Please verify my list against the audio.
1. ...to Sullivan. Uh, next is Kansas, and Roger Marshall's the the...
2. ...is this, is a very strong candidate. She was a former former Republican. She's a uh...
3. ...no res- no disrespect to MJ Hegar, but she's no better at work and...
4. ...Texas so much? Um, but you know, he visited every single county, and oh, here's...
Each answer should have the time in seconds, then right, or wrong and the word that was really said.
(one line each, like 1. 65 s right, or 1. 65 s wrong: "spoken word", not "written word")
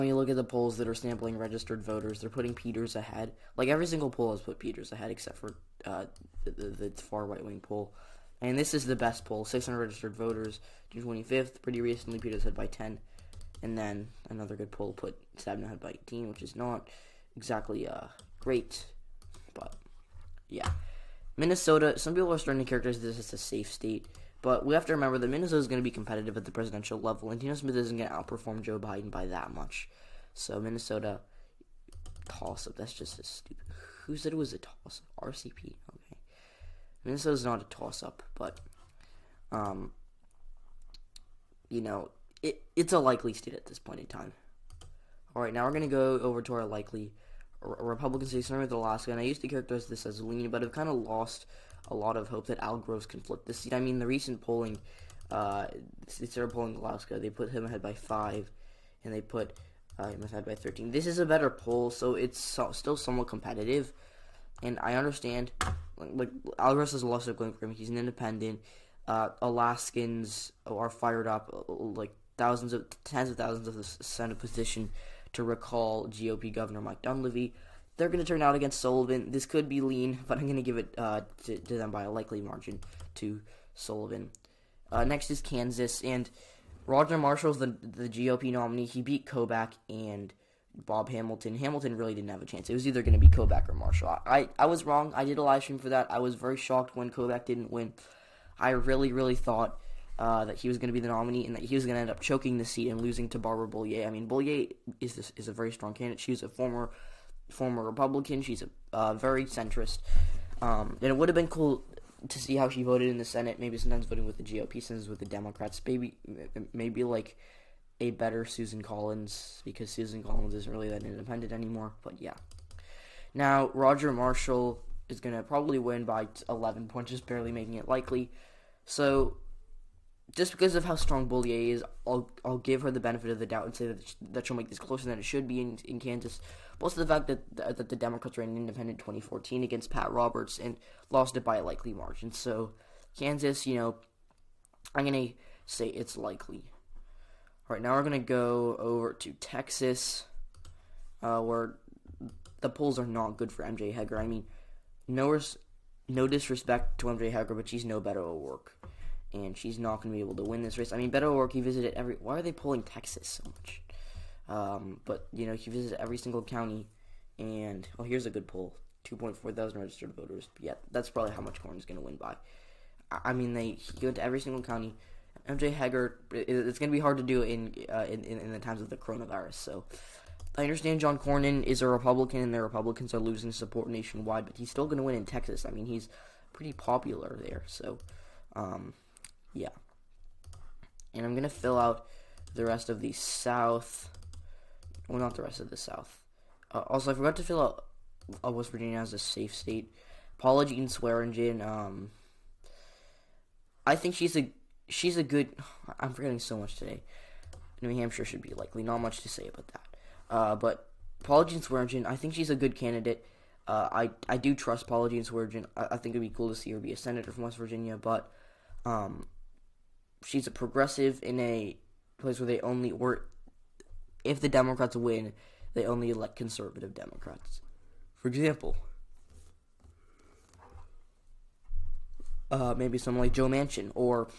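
1. 83 s right
2. 104 s right
3. 155 s right
4. 162 s right.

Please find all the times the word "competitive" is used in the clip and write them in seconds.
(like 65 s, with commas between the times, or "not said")
25 s, 63 s.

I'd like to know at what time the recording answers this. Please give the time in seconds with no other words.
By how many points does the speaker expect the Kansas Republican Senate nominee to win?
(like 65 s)
126 s.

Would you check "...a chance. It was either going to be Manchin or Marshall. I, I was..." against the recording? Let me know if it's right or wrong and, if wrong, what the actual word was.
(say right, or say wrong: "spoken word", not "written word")
wrong: "Kobach", not "Manchin".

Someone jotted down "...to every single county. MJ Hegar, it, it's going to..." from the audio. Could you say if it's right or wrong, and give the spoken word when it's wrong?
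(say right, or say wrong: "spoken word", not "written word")
right.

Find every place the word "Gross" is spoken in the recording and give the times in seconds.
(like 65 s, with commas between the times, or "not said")
52 s, 66 s.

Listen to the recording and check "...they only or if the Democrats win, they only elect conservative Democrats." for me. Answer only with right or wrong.
right.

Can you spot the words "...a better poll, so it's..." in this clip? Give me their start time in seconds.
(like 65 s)
61 s.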